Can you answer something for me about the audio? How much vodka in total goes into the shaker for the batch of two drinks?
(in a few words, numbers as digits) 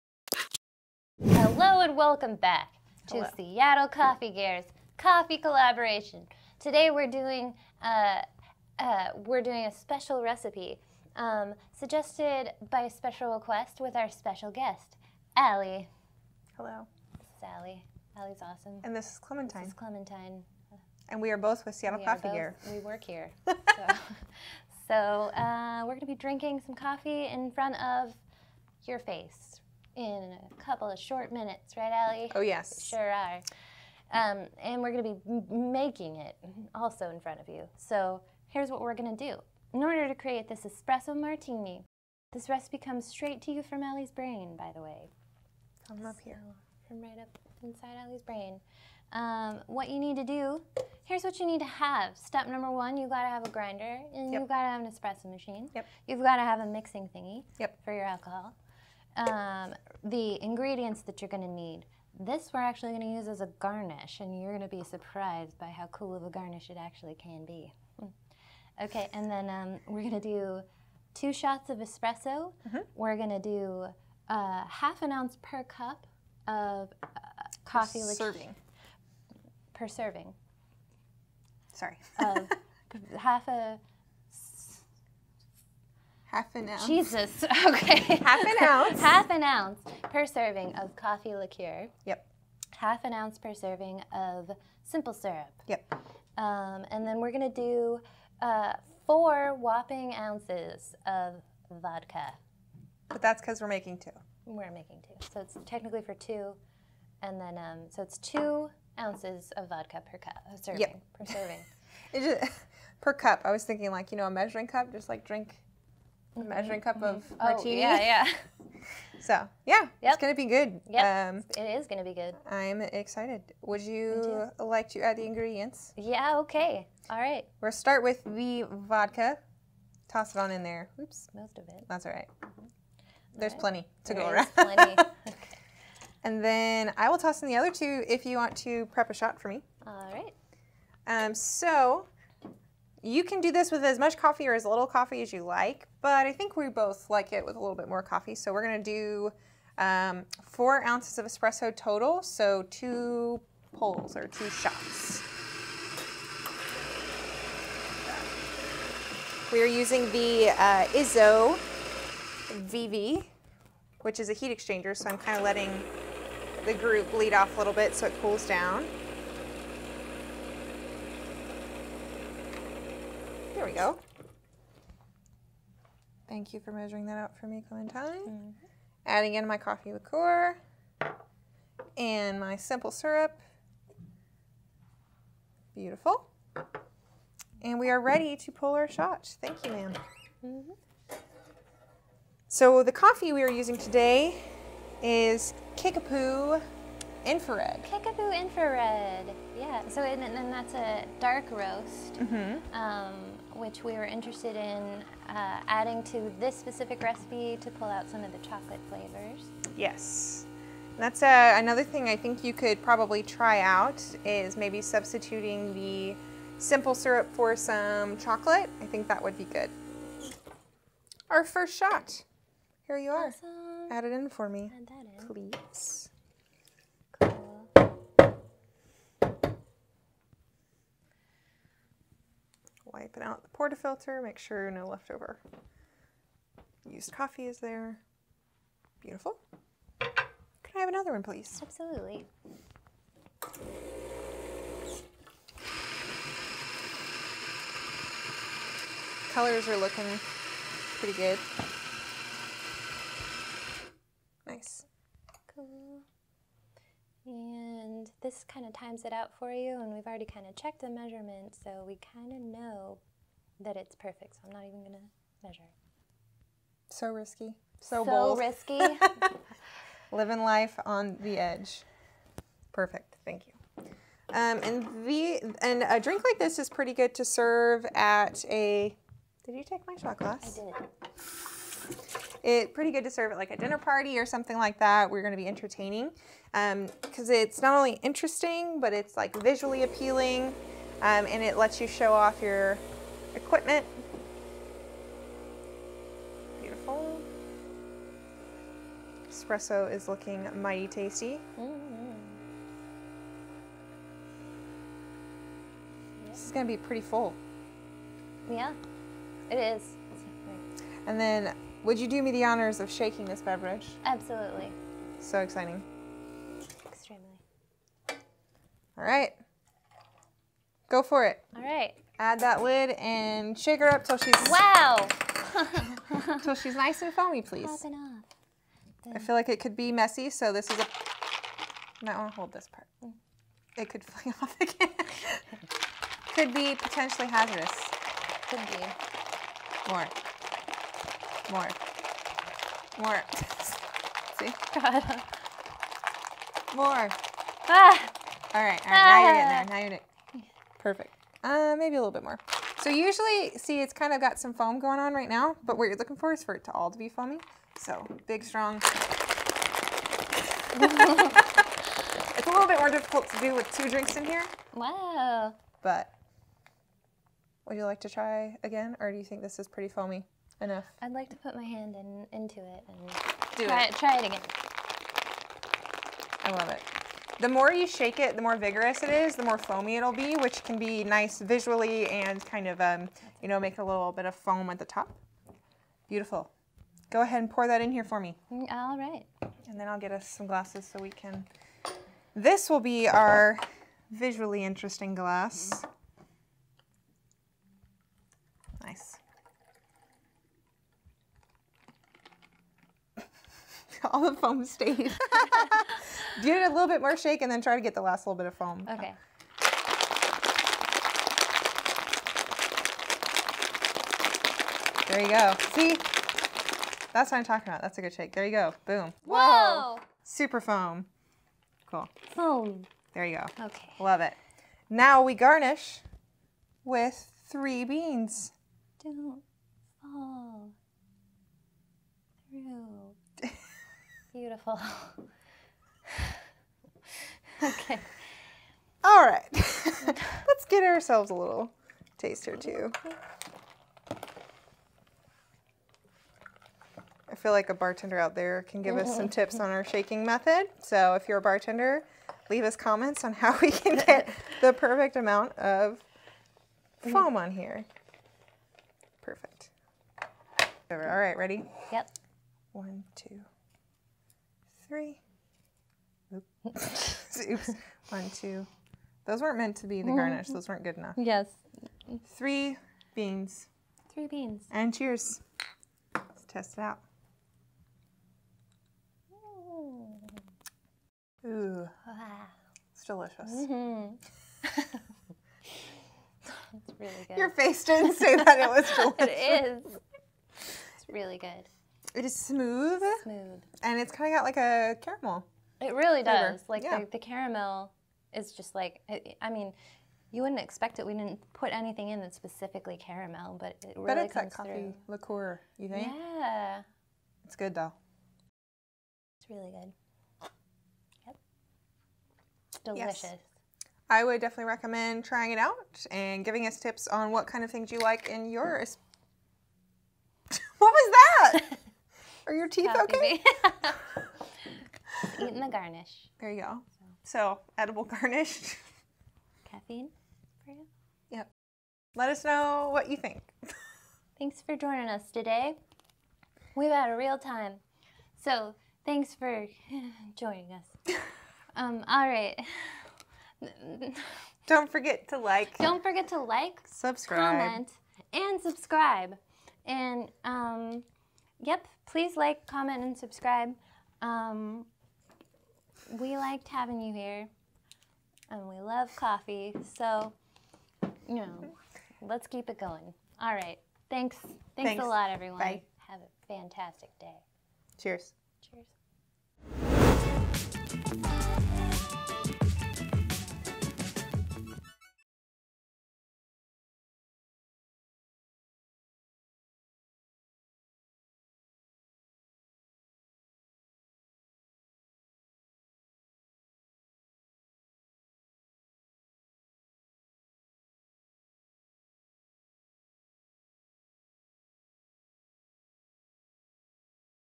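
4 ounces.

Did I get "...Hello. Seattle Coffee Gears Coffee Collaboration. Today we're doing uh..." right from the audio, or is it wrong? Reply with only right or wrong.
right.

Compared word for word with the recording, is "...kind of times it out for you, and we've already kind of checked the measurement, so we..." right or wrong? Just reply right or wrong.
right.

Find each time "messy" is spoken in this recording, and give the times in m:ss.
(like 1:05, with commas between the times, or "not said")
5:29.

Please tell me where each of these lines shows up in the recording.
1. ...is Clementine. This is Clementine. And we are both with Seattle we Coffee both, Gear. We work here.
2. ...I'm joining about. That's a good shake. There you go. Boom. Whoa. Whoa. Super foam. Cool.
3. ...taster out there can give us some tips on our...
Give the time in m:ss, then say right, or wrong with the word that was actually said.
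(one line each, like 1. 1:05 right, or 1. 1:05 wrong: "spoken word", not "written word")
1. 0:19 right
2. 6:57 wrong: "talking", not "joining"
3. 7:27 wrong: "bartender", not "taster".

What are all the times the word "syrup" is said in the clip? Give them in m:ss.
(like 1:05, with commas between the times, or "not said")
1:35, 3:02, 3:36.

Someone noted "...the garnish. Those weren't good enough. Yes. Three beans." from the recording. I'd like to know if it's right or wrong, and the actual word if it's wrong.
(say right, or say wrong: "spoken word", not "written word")
right.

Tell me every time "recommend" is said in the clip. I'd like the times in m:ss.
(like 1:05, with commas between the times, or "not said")
8:34.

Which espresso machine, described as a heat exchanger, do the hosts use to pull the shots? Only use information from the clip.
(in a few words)
Izzo Vivi.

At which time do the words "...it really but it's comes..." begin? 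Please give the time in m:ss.
8:23.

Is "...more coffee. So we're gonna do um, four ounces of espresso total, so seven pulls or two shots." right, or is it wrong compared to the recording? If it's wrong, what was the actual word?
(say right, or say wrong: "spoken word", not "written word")
wrong: "two", not "seven".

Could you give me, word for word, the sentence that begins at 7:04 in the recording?
Now we garnish with three beans.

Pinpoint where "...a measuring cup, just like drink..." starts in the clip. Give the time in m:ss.
1:54.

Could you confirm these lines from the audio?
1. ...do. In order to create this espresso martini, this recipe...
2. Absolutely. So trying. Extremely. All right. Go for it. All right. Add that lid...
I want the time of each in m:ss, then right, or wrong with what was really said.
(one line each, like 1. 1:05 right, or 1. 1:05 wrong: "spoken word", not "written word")
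1. 0:39 right
2. 5:14 wrong: "exciting", not "trying".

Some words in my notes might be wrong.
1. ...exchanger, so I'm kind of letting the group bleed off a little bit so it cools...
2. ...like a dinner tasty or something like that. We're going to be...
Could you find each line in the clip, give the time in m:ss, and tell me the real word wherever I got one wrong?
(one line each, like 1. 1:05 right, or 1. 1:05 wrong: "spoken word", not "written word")
1. 2:44 right
2. 4:43 wrong: "party", not "tasty".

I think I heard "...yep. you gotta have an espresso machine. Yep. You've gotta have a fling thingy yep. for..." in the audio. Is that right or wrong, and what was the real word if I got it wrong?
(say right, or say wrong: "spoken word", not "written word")
wrong: "mixing", not "fling".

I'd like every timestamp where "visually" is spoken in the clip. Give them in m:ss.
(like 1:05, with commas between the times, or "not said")
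4:49, 6:21, 6:34.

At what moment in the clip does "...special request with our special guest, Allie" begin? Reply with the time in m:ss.
0:12.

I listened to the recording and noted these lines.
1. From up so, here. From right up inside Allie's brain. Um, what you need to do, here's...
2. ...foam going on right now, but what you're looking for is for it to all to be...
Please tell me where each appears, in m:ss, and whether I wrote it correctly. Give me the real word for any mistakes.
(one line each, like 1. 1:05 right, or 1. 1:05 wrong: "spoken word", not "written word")
1. 0:45 right
2. 5:54 right.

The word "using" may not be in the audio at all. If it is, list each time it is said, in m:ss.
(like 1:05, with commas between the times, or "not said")
2:39, 3:13.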